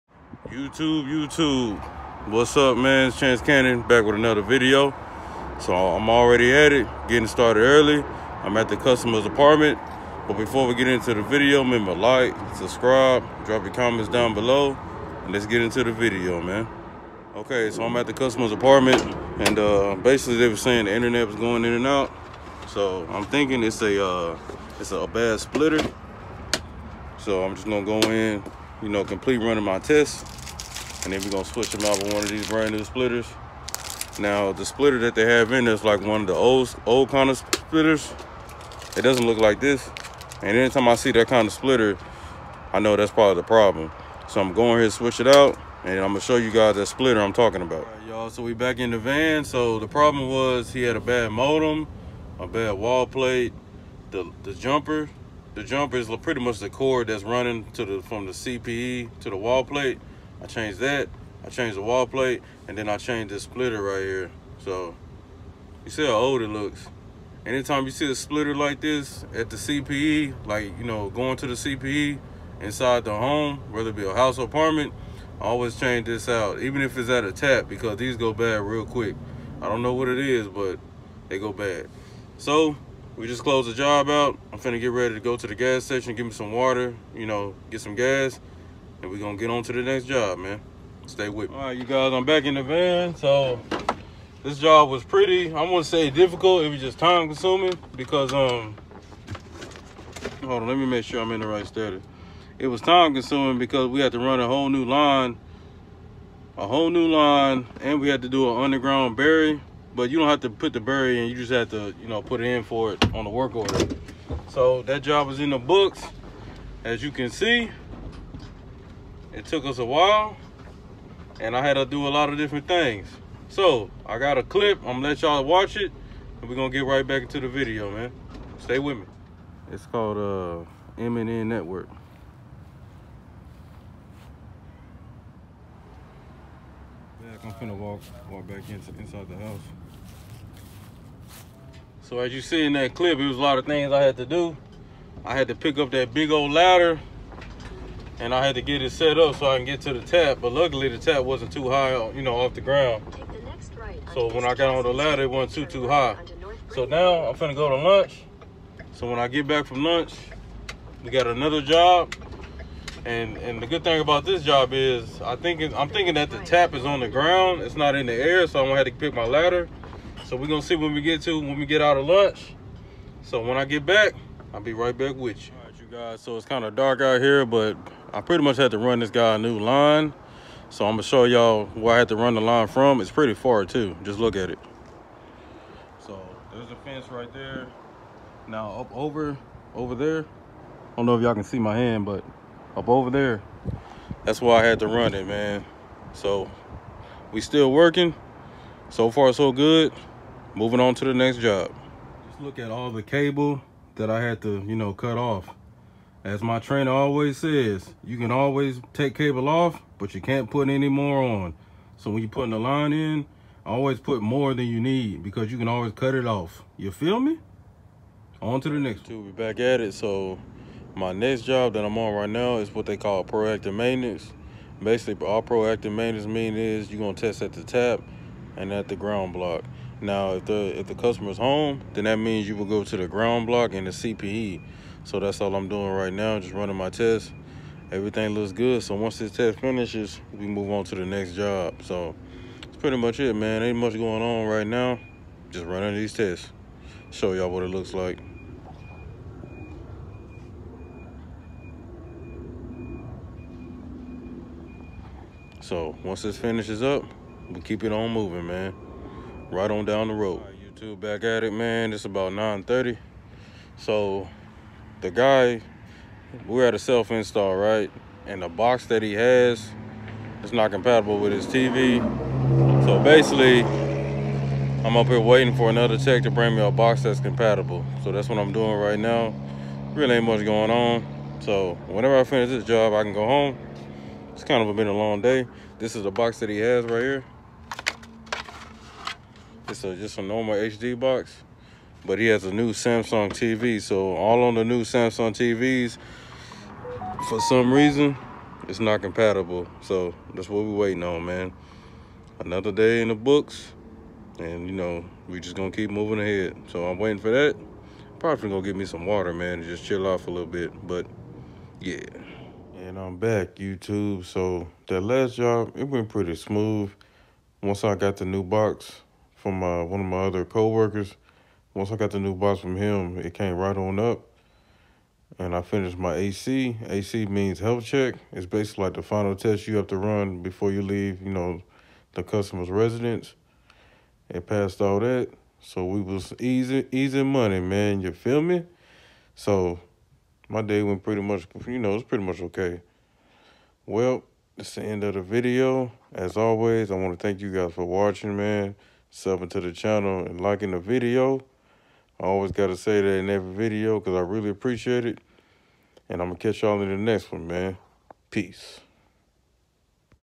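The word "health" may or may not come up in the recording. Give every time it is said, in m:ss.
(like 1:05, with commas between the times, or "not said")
5:27.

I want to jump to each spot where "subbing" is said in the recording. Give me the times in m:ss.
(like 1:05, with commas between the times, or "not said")
5:49.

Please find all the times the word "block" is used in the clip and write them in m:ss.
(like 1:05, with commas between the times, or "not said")
3:49, 3:53.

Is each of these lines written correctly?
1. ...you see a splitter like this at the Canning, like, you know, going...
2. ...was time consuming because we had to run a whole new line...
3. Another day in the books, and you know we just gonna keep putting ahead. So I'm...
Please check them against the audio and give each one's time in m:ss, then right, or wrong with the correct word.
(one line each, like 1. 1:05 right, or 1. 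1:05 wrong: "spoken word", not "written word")
1. 1:07 wrong: "CPE", not "Canning"
2. 1:42 right
3. 5:02 wrong: "moving", not "putting".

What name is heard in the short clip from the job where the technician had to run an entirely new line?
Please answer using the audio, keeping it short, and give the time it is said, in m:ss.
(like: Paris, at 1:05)
M&N Network, at 2:11.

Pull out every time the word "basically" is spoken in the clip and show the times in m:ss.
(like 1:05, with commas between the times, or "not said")
0:20, 3:44, 4:33, 5:28.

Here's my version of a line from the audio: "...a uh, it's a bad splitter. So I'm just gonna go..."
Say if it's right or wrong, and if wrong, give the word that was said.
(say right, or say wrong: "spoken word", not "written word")
right.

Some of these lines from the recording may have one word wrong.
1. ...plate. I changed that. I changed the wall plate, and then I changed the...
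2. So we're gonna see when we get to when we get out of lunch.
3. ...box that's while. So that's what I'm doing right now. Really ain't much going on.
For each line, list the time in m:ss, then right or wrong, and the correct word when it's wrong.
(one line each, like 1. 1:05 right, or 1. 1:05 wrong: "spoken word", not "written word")
1. 0:59 right
2. 2:50 right
3. 4:36 wrong: "compatible", not "while".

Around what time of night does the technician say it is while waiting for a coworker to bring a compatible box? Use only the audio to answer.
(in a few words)
9:30.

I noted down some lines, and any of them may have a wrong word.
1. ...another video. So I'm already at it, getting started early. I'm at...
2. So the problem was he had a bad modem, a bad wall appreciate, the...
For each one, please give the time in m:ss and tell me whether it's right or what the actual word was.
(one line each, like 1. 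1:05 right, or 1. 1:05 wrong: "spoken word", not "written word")
1. 0:04 right
2. 0:49 wrong: "plate", not "appreciate".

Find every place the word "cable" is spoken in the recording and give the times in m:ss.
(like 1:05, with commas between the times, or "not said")
3:23, 3:29.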